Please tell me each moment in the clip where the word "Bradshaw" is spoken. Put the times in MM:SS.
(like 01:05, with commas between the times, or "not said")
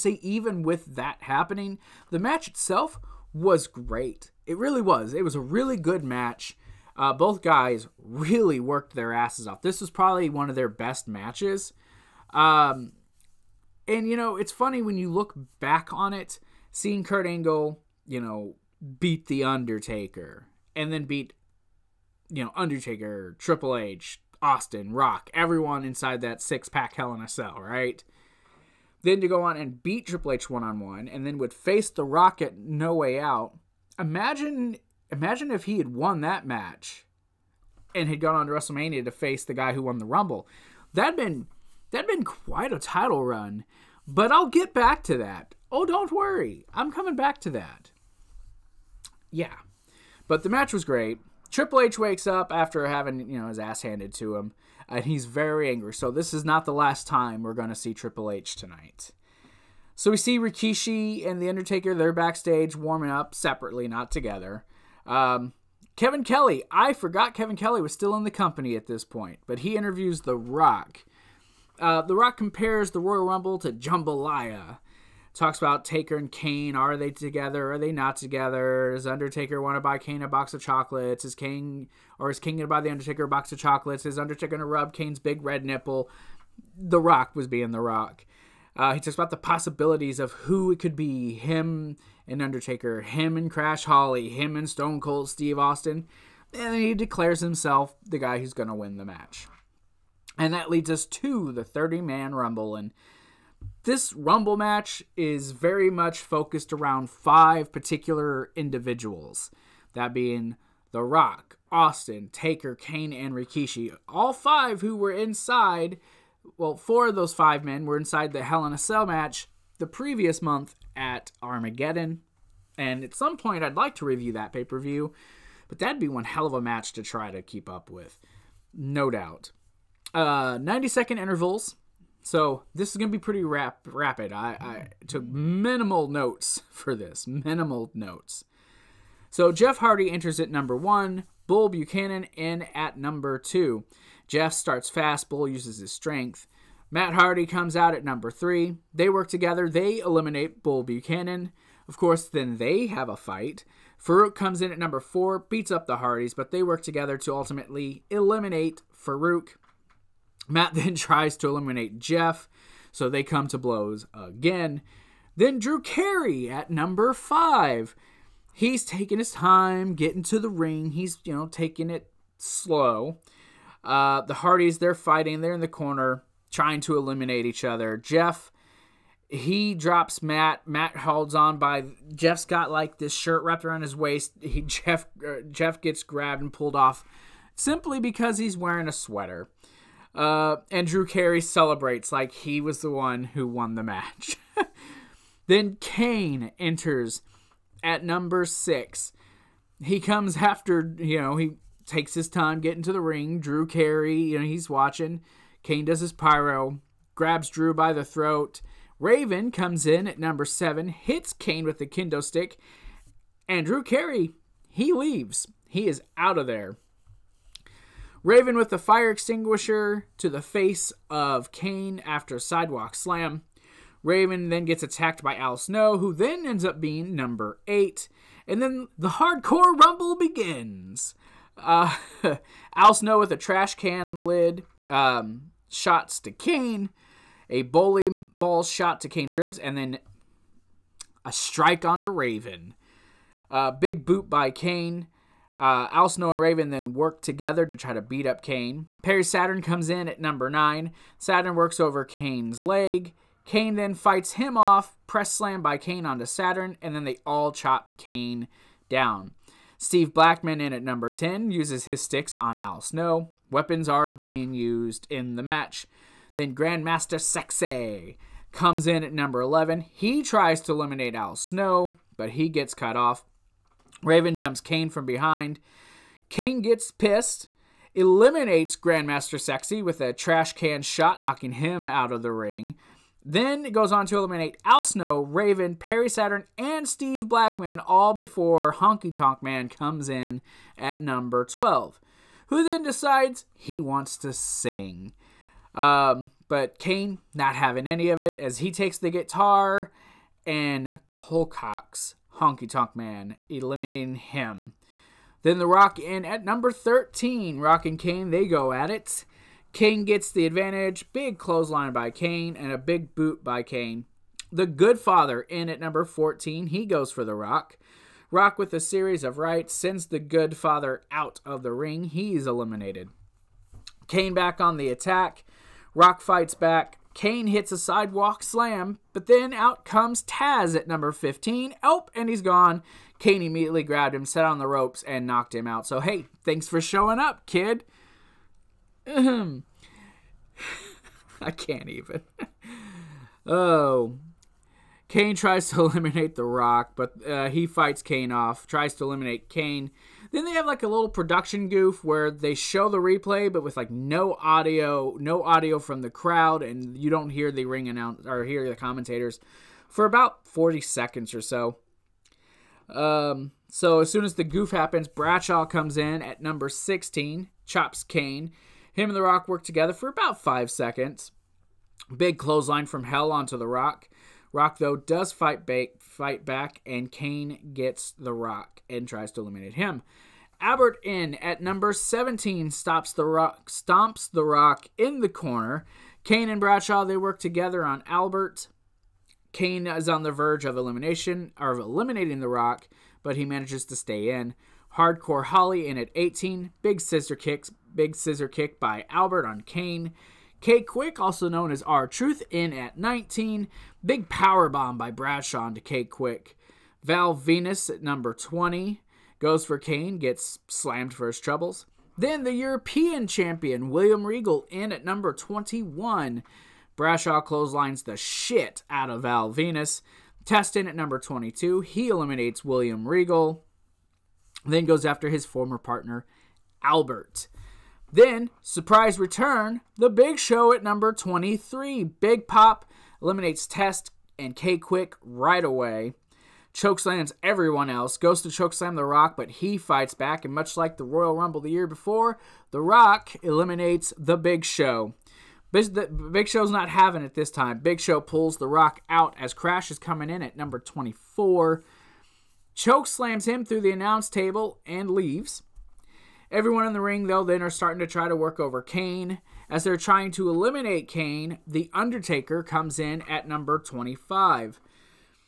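06:05, 06:26, 06:45, 06:56.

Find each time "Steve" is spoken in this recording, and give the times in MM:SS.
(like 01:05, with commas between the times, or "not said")
01:35, 04:19, 04:46.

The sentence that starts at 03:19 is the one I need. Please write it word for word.
He comes after you know he takes his time getting to the ring.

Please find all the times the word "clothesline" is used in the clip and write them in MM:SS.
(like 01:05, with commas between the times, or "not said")
05:11, 06:12, 06:57.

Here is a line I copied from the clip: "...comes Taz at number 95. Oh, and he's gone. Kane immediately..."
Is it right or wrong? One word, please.
wrong.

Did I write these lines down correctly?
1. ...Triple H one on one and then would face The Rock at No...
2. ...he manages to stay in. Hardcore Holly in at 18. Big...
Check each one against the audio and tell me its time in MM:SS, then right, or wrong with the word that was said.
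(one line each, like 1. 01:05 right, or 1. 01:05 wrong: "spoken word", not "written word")
1. 00:30 right
2. 06:33 right.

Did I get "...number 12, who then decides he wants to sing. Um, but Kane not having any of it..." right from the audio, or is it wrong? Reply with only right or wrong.
right.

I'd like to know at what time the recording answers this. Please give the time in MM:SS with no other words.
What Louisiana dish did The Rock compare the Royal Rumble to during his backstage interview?
01:13.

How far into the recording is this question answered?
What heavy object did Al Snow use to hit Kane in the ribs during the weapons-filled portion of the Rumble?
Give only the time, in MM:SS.
03:57.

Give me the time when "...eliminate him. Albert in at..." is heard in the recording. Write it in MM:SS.
06:19.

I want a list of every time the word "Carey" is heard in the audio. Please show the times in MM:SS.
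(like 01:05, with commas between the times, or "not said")
02:45, 03:11, 03:23, 03:33.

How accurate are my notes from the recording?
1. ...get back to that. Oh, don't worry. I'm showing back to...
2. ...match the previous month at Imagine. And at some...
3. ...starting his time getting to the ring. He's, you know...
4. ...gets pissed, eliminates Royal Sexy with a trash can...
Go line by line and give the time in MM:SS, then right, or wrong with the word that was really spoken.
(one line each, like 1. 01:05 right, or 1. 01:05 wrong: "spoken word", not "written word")
1. 00:44 wrong: "coming", not "showing"
2. 01:59 wrong: "Armageddon", not "Imagine"
3. 02:48 wrong: "taking", not "starting"
4. 04:36 wrong: "Grandmaster", not "Royal".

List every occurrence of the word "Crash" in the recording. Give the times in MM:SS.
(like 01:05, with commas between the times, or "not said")
01:33, 07:29.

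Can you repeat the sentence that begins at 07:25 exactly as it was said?
Big Show's not having it this time.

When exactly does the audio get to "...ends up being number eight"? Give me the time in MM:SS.
03:46.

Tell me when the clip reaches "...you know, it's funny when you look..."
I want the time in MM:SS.
00:14.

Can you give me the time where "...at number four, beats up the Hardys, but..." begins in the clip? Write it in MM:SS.
02:34.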